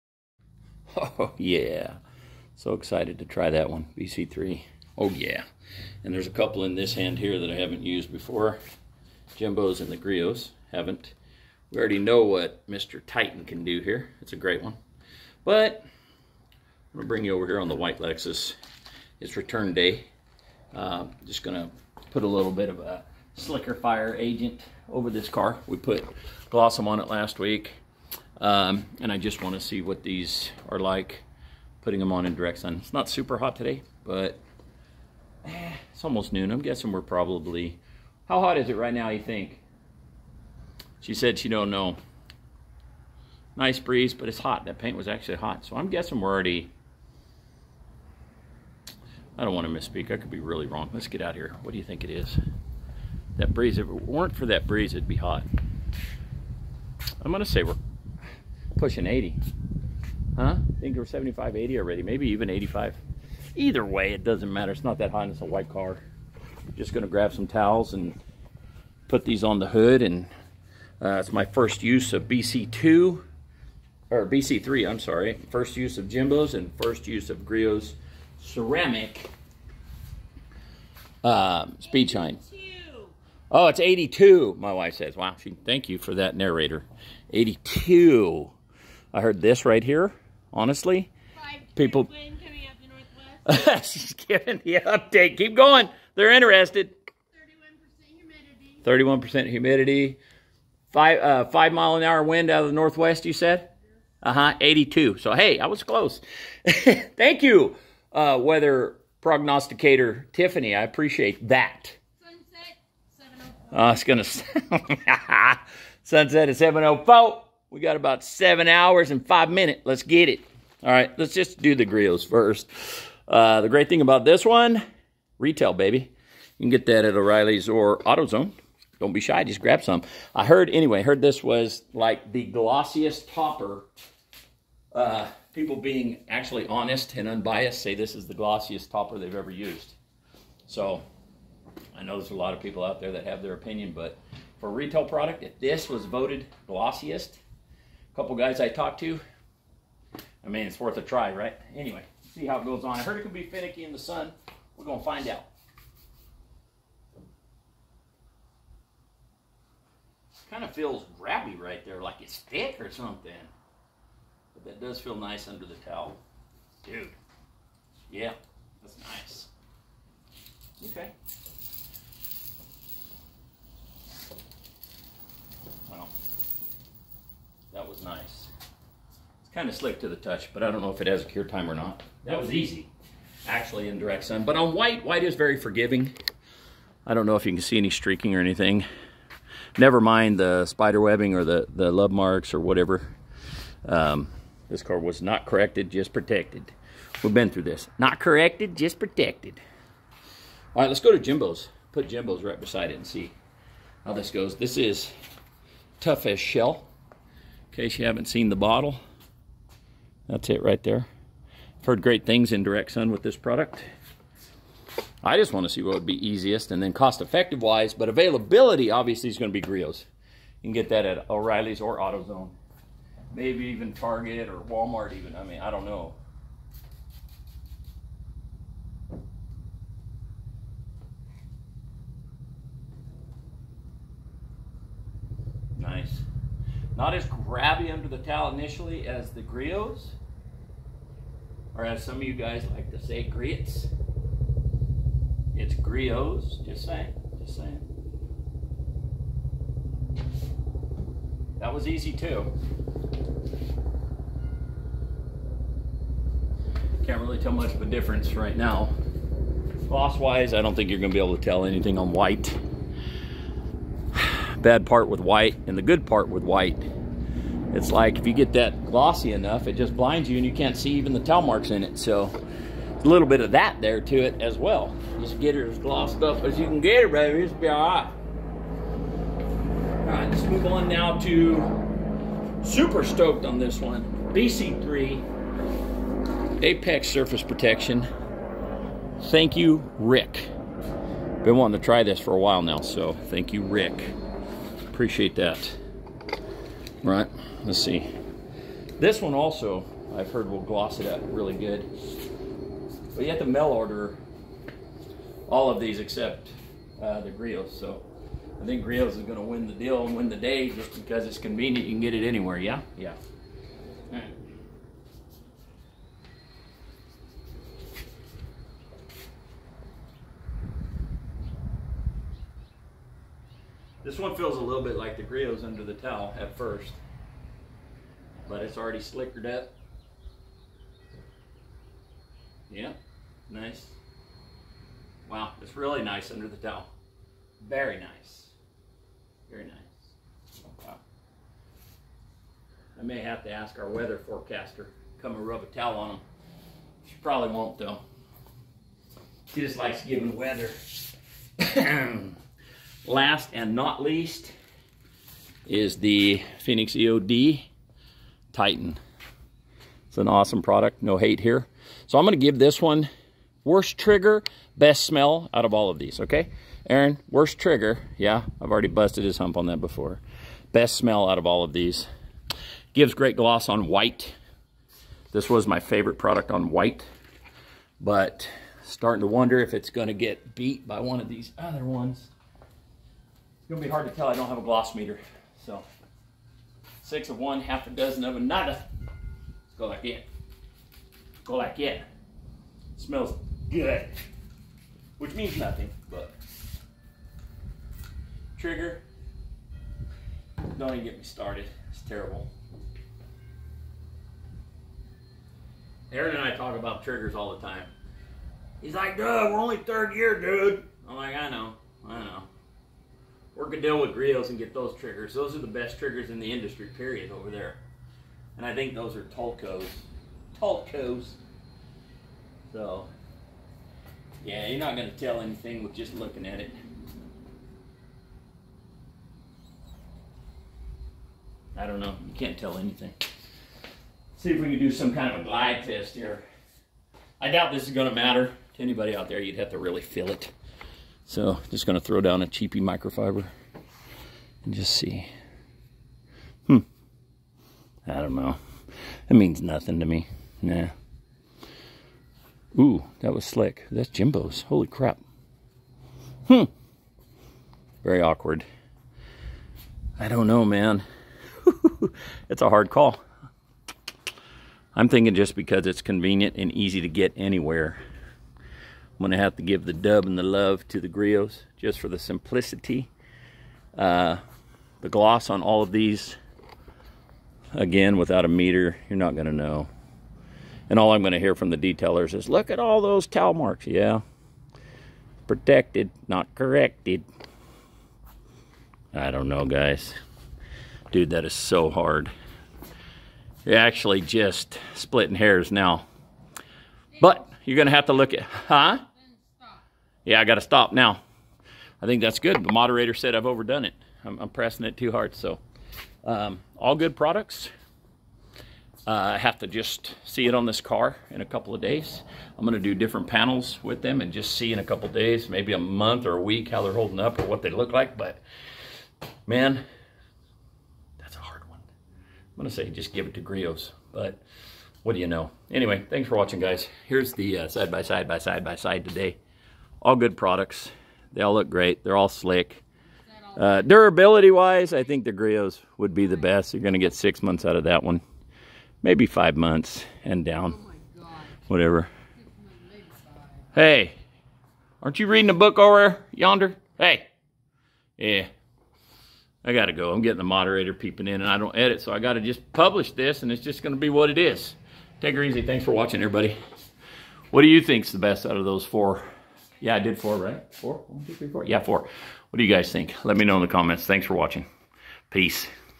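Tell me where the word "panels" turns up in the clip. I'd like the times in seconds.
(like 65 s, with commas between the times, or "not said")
513 s.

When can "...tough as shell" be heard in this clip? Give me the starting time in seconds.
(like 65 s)
205 s.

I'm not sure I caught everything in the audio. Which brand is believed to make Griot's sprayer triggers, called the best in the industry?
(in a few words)
Tolco.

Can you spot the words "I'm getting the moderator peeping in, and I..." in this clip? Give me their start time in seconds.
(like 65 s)
550 s.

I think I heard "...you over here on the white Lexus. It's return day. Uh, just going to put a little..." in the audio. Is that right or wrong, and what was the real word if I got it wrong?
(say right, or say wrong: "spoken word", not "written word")
right.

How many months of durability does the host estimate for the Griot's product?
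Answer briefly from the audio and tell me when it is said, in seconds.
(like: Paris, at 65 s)
6, at 536 s.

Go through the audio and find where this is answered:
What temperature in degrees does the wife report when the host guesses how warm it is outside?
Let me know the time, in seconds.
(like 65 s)
83 s.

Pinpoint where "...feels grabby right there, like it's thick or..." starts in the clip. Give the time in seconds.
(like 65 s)
160 s.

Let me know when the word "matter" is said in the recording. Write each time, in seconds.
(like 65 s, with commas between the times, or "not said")
64 s, 438 s.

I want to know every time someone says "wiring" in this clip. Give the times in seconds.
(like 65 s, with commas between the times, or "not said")
not said.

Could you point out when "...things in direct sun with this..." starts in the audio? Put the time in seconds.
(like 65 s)
212 s.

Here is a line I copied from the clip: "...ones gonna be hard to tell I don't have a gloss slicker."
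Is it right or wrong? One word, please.
wrong.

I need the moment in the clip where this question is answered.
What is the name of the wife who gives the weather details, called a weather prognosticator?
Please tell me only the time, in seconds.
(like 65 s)
108 s.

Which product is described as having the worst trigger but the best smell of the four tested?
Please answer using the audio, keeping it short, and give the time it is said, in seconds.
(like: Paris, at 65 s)
Phoenix EOD Titan, at 356 s.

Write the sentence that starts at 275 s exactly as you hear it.
Just get it as glossed up as you can get it, baby.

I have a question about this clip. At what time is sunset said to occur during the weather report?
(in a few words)
7.04.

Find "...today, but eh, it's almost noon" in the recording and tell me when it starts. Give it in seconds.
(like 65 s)
33 s.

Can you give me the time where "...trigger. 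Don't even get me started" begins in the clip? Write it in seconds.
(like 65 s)
398 s.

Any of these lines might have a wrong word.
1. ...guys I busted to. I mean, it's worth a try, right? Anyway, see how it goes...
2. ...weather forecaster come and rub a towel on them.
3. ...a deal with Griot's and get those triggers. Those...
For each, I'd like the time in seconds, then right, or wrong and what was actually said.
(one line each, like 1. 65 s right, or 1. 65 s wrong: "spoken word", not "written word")
1. 148 s wrong: "talked", not "busted"
2. 343 s right
3. 413 s right.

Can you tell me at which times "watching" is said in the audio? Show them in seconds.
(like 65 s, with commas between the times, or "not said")
526 s, 555 s, 564 s.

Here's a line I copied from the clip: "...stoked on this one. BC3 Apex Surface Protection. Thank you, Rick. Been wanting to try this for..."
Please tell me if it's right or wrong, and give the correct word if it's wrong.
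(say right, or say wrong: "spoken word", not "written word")
right.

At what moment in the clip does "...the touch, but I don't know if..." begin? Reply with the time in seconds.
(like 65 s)
180 s.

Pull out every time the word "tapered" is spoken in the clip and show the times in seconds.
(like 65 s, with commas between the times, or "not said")
not said.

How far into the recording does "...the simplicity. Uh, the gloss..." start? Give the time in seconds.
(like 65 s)
472 s.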